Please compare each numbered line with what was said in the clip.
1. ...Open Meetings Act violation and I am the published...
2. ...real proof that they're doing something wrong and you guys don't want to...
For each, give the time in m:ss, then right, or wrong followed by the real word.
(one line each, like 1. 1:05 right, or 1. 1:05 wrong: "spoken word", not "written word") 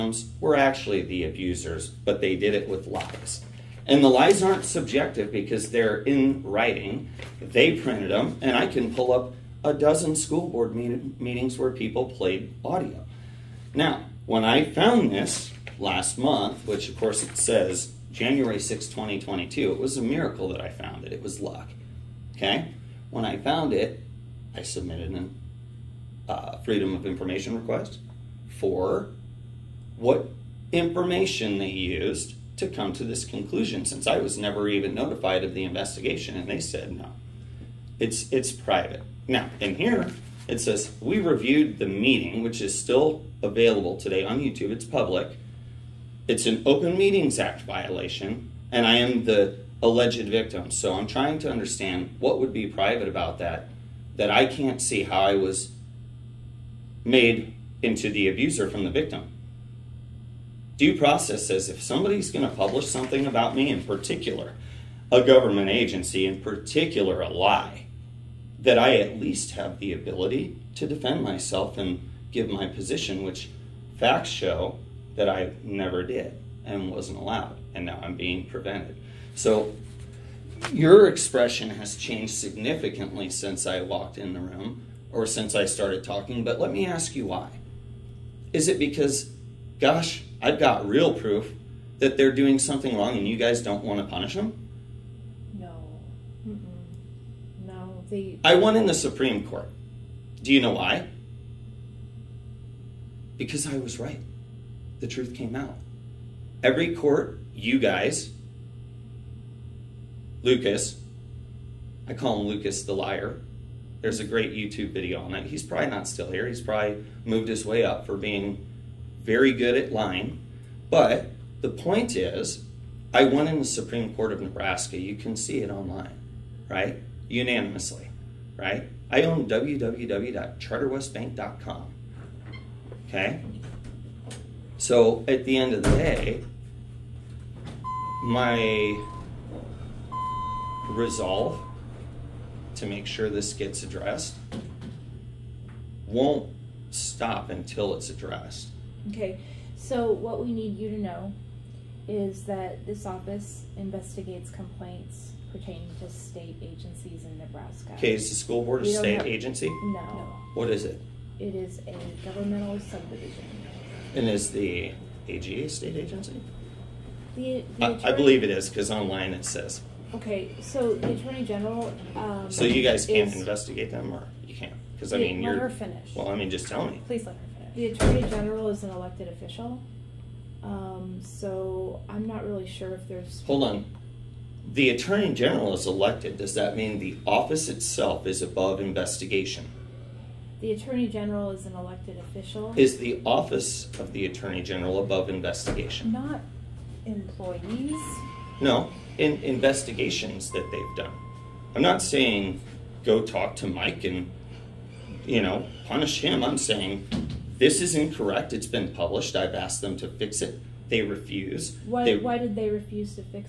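1. 0:46 wrong: "alleged", not "published"
2. 1:30 right.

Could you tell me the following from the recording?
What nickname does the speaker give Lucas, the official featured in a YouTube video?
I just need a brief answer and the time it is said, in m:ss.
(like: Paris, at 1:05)
Lucas the liar, at 1:52.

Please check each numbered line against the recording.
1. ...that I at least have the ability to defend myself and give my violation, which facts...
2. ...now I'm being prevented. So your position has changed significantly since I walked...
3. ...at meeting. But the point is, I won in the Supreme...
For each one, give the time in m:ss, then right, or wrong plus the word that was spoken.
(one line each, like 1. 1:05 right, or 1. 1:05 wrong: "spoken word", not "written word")
1. 1:08 wrong: "position", not "violation"
2. 1:17 wrong: "expression", not "position"
3. 1:59 wrong: "lying", not "meeting".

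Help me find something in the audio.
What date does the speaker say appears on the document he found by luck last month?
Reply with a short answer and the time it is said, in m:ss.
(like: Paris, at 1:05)
January 6, 2022, at 0:18.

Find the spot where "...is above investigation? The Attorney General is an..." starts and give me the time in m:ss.
3:08.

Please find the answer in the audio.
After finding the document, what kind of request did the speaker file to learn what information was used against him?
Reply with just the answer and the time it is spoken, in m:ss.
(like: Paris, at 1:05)
Freedom of Information request, at 0:26.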